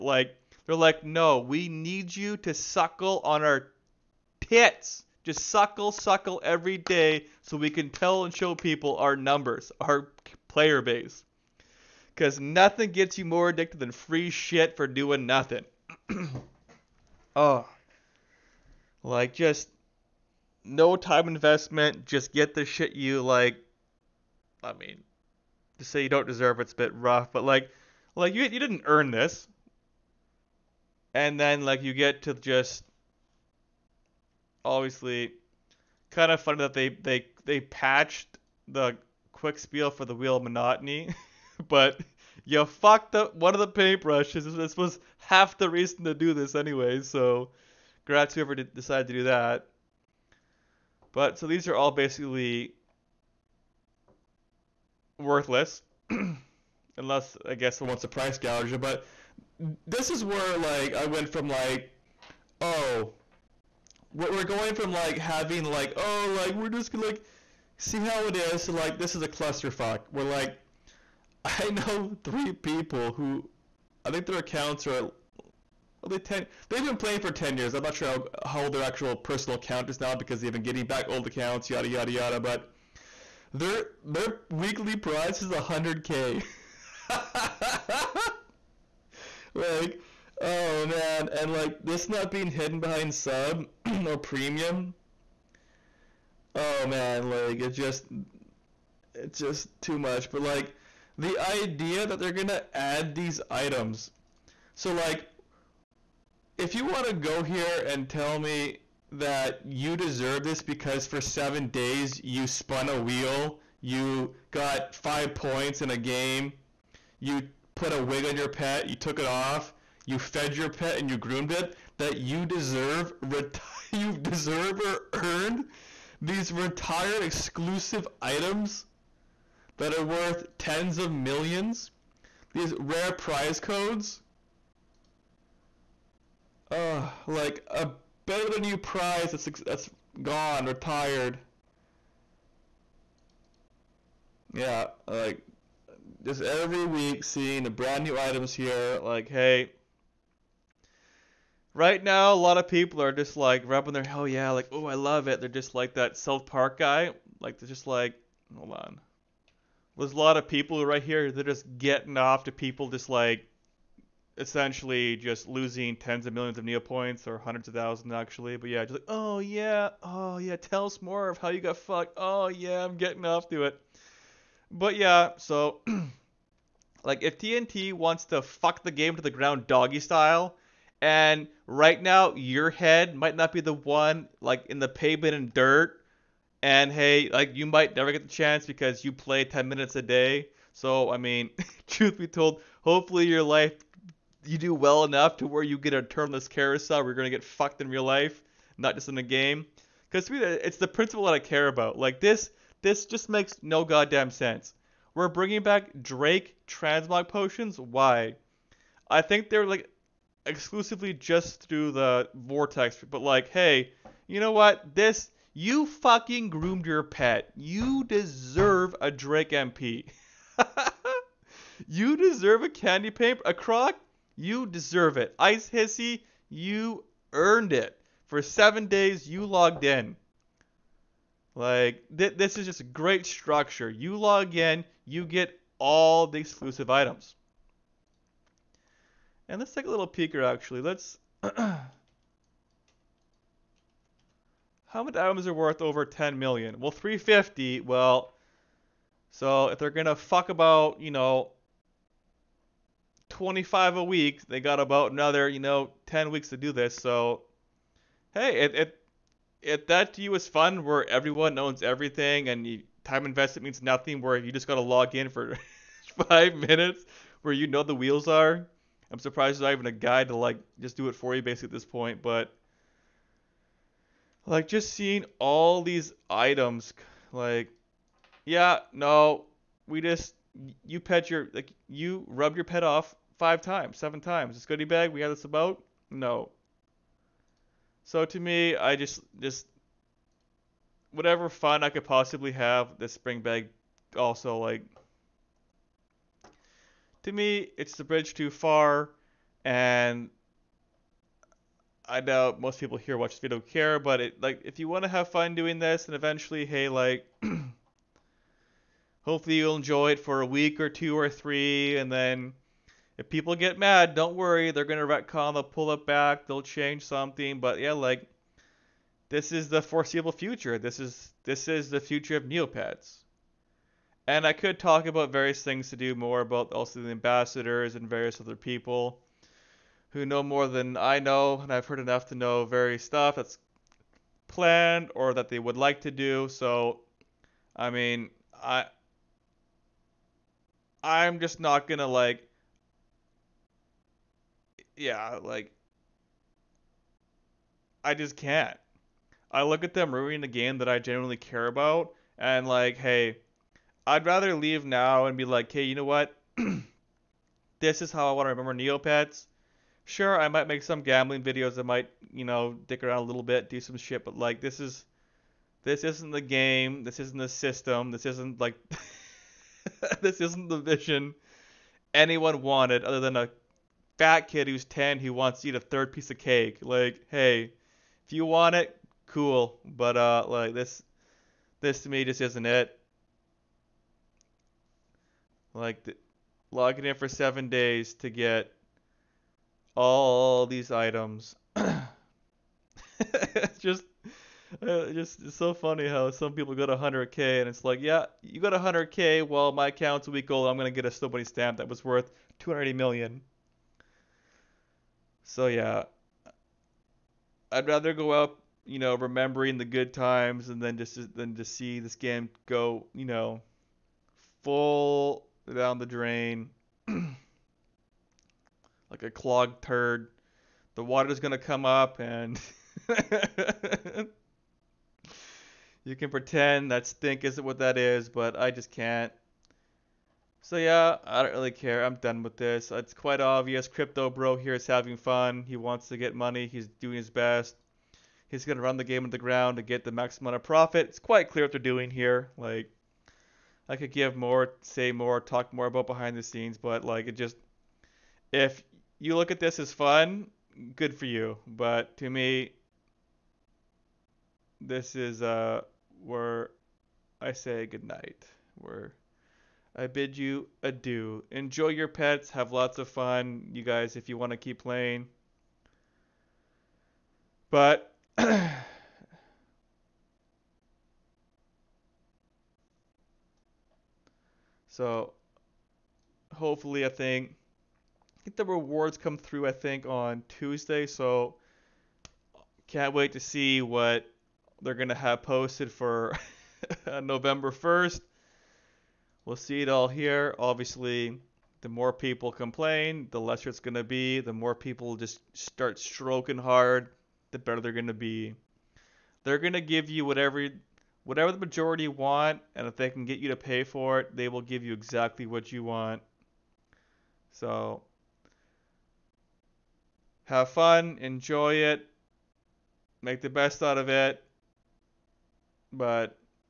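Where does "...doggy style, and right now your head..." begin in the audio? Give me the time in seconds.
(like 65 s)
179 s.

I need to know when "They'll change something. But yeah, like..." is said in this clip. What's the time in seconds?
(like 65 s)
316 s.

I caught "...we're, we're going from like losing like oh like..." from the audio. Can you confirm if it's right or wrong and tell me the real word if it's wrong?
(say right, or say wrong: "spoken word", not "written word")
wrong: "having", not "losing".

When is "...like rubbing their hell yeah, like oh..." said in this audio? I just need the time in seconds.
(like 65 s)
153 s.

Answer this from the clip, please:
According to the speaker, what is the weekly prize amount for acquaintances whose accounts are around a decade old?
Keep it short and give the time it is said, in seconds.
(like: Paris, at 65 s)
100K, at 84 s.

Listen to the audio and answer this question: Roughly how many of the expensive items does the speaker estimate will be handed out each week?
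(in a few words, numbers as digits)
25.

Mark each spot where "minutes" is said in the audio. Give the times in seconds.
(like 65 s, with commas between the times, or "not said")
189 s, 266 s.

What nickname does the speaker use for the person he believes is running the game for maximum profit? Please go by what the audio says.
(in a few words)
Crypto Bro.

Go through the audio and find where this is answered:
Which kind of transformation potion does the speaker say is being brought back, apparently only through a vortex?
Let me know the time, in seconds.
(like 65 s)
206 s.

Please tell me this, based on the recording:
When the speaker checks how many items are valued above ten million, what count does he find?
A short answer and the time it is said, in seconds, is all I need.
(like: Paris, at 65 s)
350, at 246 s.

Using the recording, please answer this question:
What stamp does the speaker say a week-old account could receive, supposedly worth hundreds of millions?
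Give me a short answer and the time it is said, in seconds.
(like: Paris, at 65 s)
somebody stamp, at 401 s.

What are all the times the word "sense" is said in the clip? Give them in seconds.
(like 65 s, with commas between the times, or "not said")
204 s.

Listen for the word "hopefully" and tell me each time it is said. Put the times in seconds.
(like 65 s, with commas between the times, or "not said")
192 s, 309 s, 476 s.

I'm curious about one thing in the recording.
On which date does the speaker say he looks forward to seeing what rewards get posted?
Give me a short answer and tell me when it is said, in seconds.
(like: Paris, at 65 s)
November 1st, at 487 s.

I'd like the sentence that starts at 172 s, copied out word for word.
Oh yeah, I'm getting off to it.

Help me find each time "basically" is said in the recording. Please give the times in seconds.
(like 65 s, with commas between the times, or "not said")
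51 s, 271 s.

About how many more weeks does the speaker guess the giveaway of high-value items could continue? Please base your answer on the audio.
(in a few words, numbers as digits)
10 weeks.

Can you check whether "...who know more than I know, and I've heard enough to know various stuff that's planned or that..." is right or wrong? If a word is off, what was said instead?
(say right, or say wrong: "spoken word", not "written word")
right.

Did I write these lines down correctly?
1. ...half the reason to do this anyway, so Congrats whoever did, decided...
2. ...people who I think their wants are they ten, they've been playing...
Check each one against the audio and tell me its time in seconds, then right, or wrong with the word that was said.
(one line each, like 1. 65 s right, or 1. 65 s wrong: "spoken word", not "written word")
1. 45 s right
2. 72 s wrong: "accounts", not "wants".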